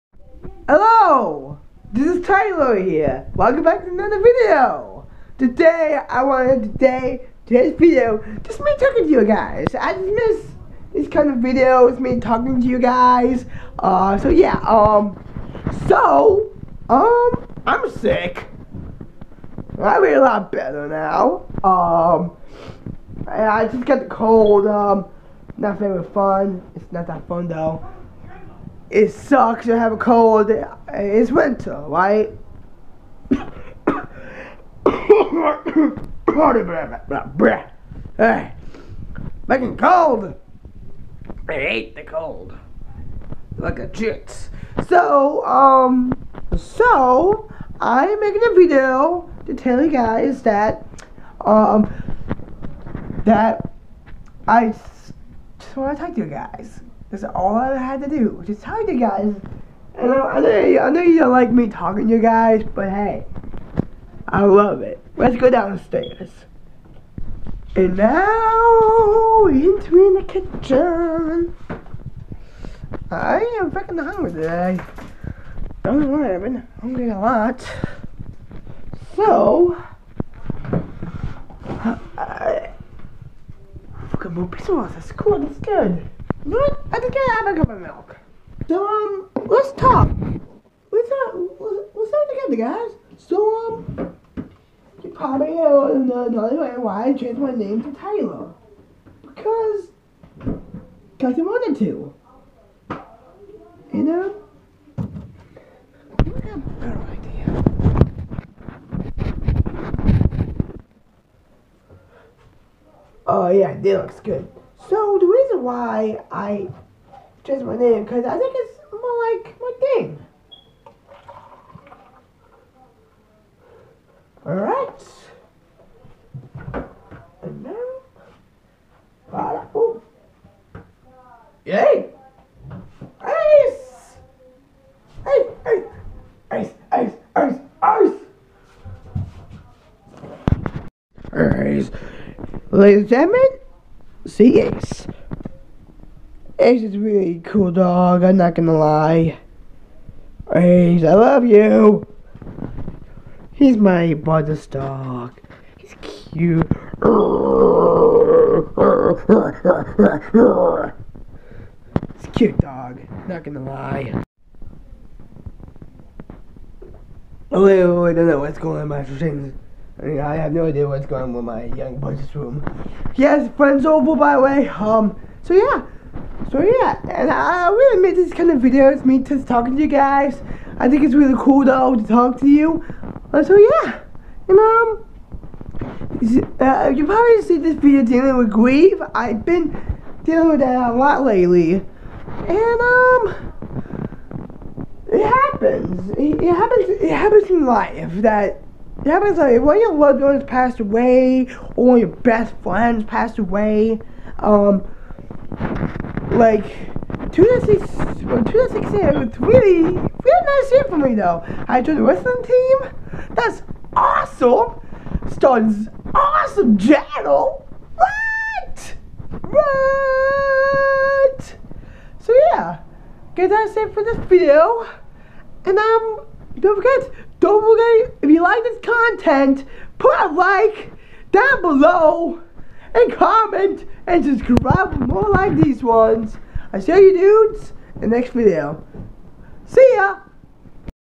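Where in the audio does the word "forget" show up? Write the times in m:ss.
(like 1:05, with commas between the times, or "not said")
3:46.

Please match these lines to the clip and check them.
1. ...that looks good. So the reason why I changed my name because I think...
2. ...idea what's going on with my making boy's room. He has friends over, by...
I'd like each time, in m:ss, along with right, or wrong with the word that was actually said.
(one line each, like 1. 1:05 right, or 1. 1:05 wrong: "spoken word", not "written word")
1. 1:53 right
2. 2:50 wrong: "young", not "making".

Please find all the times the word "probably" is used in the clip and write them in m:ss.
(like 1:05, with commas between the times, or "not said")
1:35, 3:07.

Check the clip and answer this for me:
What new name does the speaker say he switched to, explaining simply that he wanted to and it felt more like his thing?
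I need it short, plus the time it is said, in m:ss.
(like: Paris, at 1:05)
Taylor, at 1:37.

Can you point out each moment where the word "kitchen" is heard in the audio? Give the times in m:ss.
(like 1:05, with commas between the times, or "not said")
1:10.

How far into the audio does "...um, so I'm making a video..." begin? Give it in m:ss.
0:45.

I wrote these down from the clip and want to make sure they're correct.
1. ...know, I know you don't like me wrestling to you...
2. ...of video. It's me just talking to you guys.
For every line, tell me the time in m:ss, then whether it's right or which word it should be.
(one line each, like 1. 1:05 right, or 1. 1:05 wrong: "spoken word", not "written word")
1. 1:00 wrong: "talking", not "wrestling"
2. 2:58 right.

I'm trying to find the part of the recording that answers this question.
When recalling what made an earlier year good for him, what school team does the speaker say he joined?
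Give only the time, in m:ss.
3:32.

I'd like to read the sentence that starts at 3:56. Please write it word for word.
I see you dudes in the next video.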